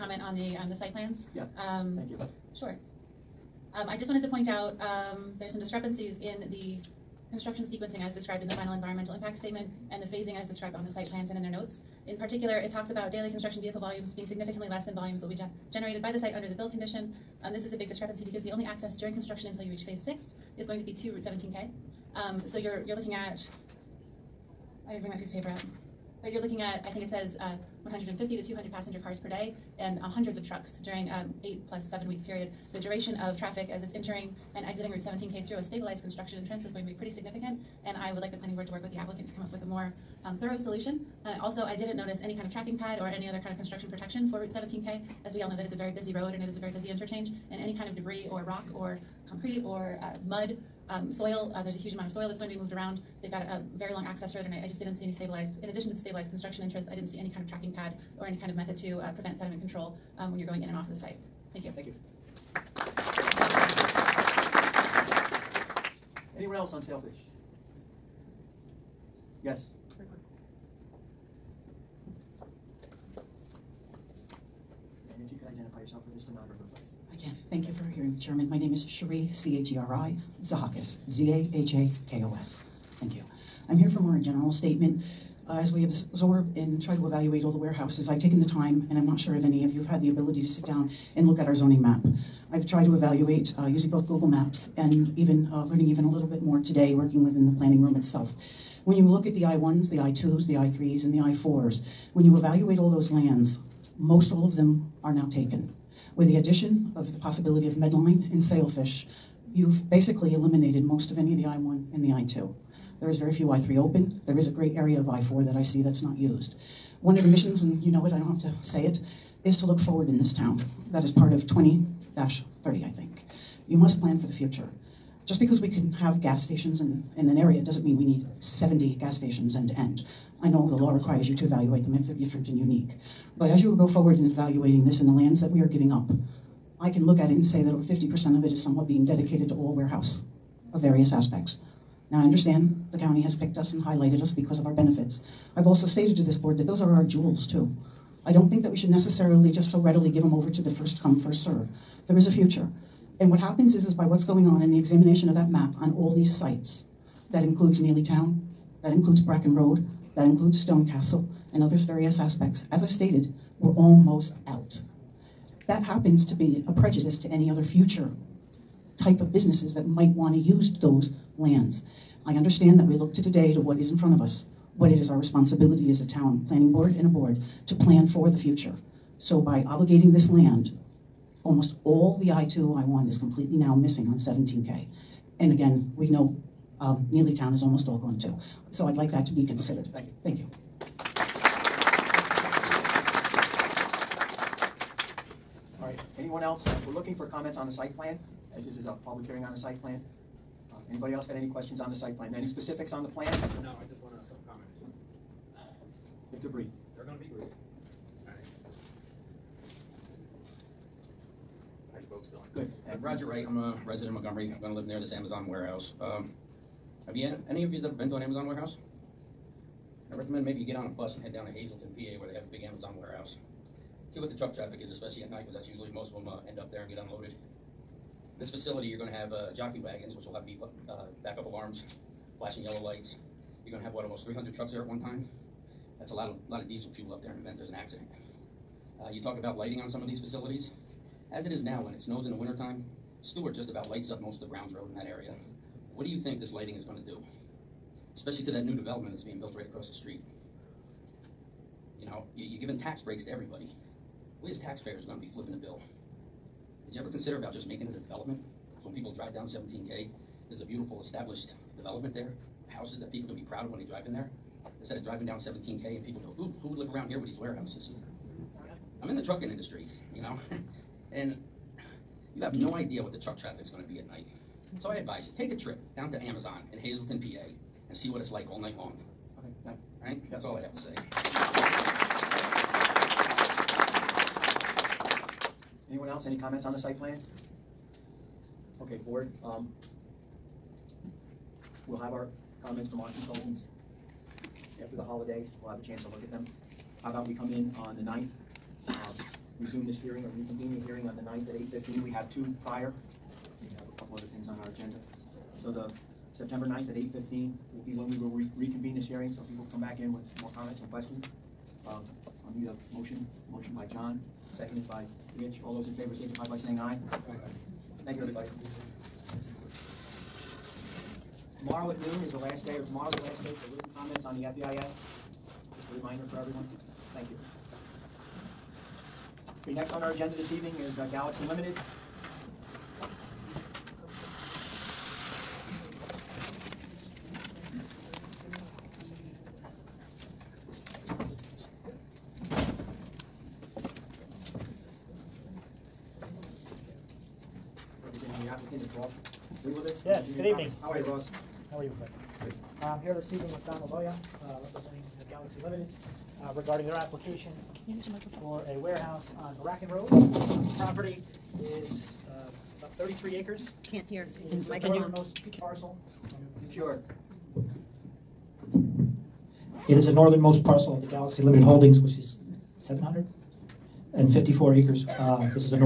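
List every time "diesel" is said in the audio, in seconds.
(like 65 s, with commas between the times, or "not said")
236 s.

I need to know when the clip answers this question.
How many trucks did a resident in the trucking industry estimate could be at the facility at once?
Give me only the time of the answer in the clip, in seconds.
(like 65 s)
234 s.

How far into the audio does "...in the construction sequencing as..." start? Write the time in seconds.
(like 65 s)
6 s.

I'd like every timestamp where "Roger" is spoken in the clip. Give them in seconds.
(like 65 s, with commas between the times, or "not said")
213 s.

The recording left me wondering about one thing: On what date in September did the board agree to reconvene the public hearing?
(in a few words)
September 9th.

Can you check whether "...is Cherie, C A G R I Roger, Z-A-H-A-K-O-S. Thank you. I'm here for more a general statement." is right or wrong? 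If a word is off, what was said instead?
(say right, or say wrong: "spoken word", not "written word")
wrong: "Zahakos", not "Roger".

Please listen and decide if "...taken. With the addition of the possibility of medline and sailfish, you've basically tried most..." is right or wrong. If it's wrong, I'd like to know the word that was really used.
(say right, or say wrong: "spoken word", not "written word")
wrong: "eliminated", not "tried".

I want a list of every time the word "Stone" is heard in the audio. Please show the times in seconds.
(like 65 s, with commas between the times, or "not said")
160 s.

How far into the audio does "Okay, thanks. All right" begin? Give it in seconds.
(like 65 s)
279 s.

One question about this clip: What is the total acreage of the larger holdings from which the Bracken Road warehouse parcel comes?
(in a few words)
754 acres.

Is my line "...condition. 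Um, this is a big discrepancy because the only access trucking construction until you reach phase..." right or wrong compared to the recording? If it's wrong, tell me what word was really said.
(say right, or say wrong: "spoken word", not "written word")
wrong: "during", not "trucking".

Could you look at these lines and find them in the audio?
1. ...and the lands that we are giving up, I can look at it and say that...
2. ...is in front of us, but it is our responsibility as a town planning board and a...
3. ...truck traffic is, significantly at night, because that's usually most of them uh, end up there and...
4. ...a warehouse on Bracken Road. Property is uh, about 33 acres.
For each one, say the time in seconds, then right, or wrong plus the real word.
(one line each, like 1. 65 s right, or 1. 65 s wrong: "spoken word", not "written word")
1. 134 s right
2. 173 s right
3. 224 s wrong: "especially", not "significantly"
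4. 358 s right.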